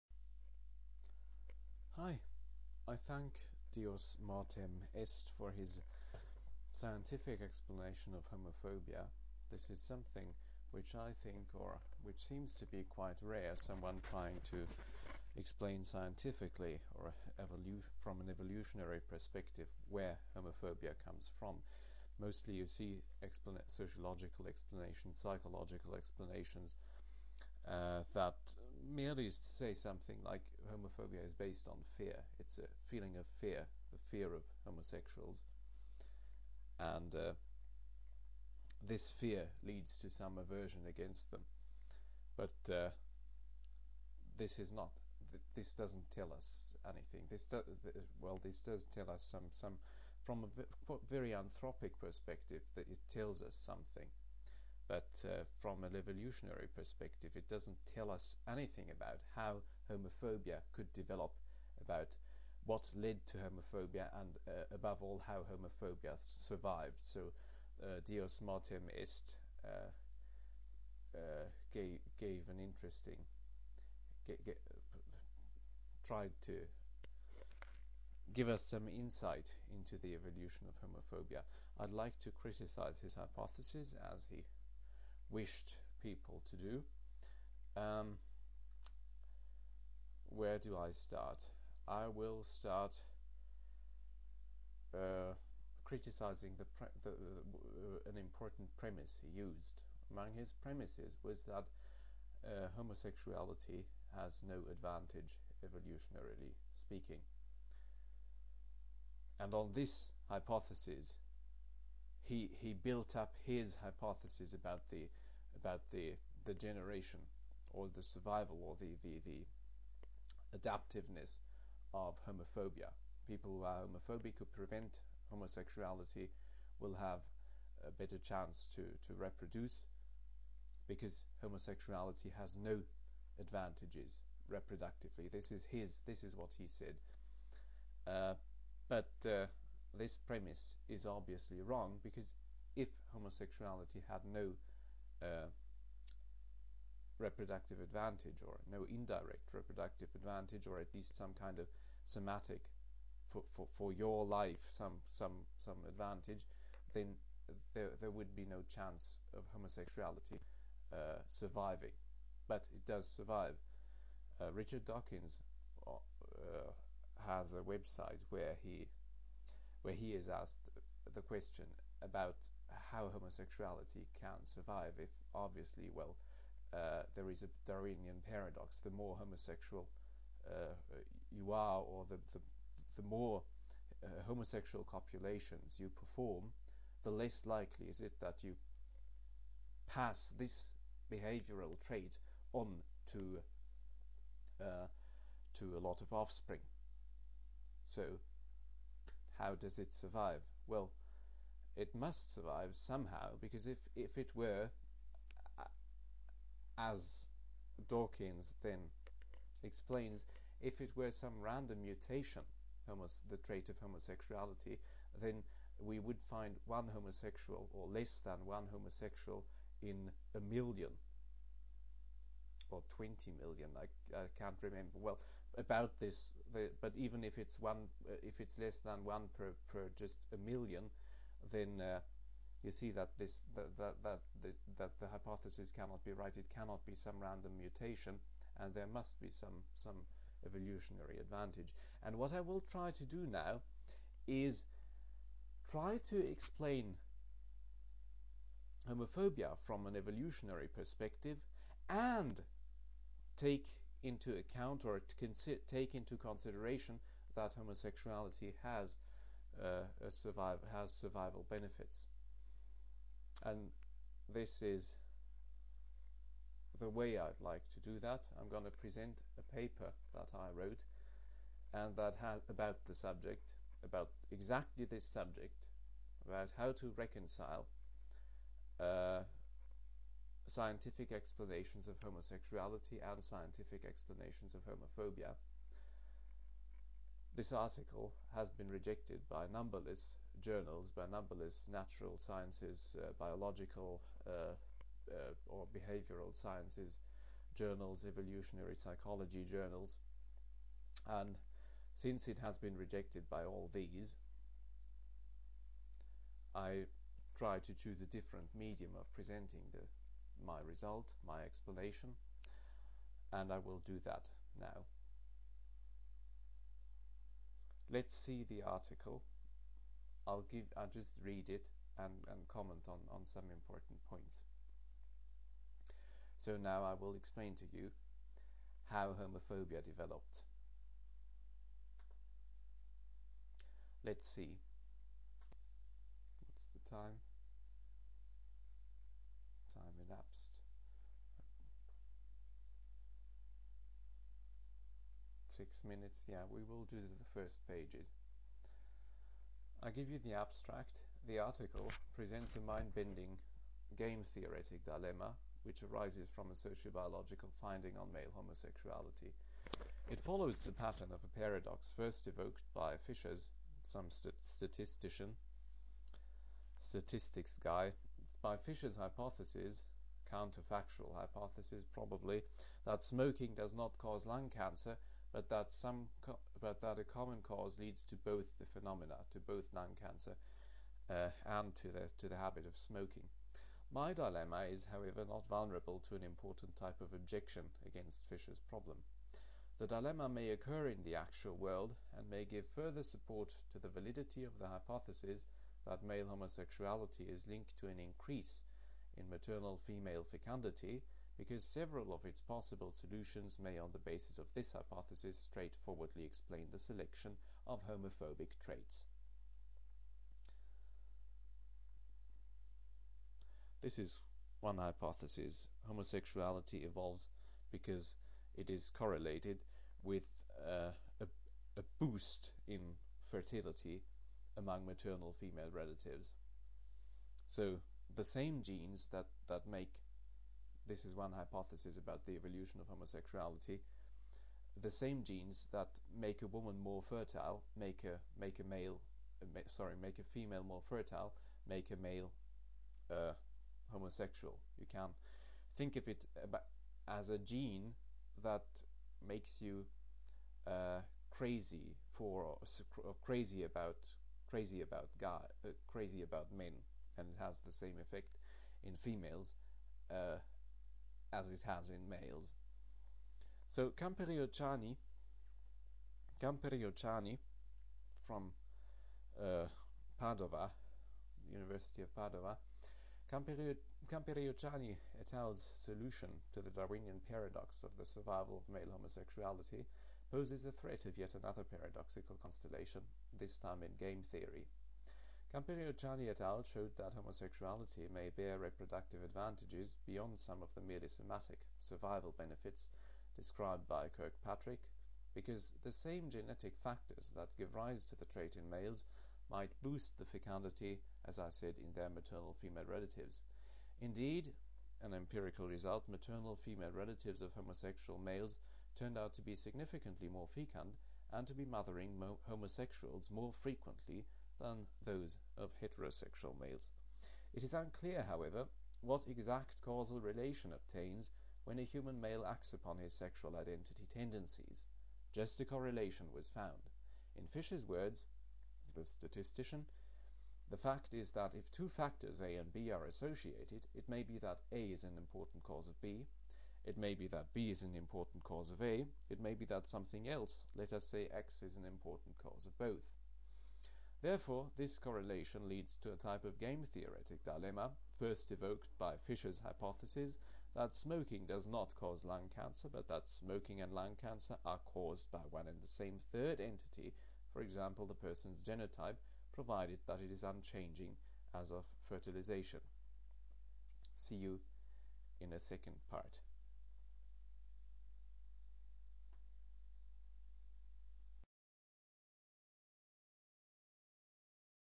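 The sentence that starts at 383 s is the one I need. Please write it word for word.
My dilemma is, however, not vulnerable to an important type of objection against Fisher's problem.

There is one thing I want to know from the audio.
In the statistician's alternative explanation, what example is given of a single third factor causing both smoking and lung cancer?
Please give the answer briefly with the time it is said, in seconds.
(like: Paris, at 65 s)
The person's genotype, at 558 s.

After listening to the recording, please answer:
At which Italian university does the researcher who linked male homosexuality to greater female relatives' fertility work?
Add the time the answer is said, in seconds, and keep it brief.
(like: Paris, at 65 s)
University of Padova, at 471 s.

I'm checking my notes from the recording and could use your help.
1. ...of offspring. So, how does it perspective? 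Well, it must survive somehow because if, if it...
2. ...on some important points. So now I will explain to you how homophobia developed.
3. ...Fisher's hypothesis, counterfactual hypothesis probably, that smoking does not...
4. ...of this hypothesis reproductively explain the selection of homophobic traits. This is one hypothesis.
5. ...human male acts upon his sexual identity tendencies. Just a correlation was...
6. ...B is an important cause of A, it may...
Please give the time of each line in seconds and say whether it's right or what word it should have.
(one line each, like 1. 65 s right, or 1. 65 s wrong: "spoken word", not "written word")
1. 196 s wrong: "survive", not "perspective"
2. 323 s right
3. 368 s right
4. 404 s wrong: "straightforwardly", not "reproductively"
5. 521 s right
6. 537 s right.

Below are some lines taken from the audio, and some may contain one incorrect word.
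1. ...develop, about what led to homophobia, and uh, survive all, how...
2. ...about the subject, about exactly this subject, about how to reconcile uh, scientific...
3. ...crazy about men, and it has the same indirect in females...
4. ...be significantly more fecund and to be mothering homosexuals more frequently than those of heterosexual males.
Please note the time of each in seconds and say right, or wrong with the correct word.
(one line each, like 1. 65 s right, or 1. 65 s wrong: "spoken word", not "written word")
1. 60 s wrong: "above", not "survive"
2. 272 s right
3. 455 s wrong: "effect", not "indirect"
4. 509 s right.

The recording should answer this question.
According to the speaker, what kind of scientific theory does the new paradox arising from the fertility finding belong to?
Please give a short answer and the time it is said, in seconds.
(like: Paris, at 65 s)
Game theory, at 484 s.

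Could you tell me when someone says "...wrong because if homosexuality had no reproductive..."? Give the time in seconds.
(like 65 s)
141 s.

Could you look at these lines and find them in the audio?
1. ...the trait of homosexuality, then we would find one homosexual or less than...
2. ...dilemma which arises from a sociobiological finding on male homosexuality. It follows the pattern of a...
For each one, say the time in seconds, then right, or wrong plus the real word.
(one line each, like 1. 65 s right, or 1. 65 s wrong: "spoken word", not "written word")
1. 213 s right
2. 354 s right.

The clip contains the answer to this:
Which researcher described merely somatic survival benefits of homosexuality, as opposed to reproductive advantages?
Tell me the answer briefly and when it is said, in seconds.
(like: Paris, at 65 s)
Kirkpatrick, at 494 s.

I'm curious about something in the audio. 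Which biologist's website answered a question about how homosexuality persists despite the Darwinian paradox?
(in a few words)
Richard Dawkins.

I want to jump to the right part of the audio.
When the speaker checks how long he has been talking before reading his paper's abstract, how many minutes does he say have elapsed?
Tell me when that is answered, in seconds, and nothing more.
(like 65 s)
345 s.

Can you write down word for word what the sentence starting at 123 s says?
People who are homophobic who prevent homosexuality will have a better chance to, to reproduce because homosexuality has no advantages reproductively.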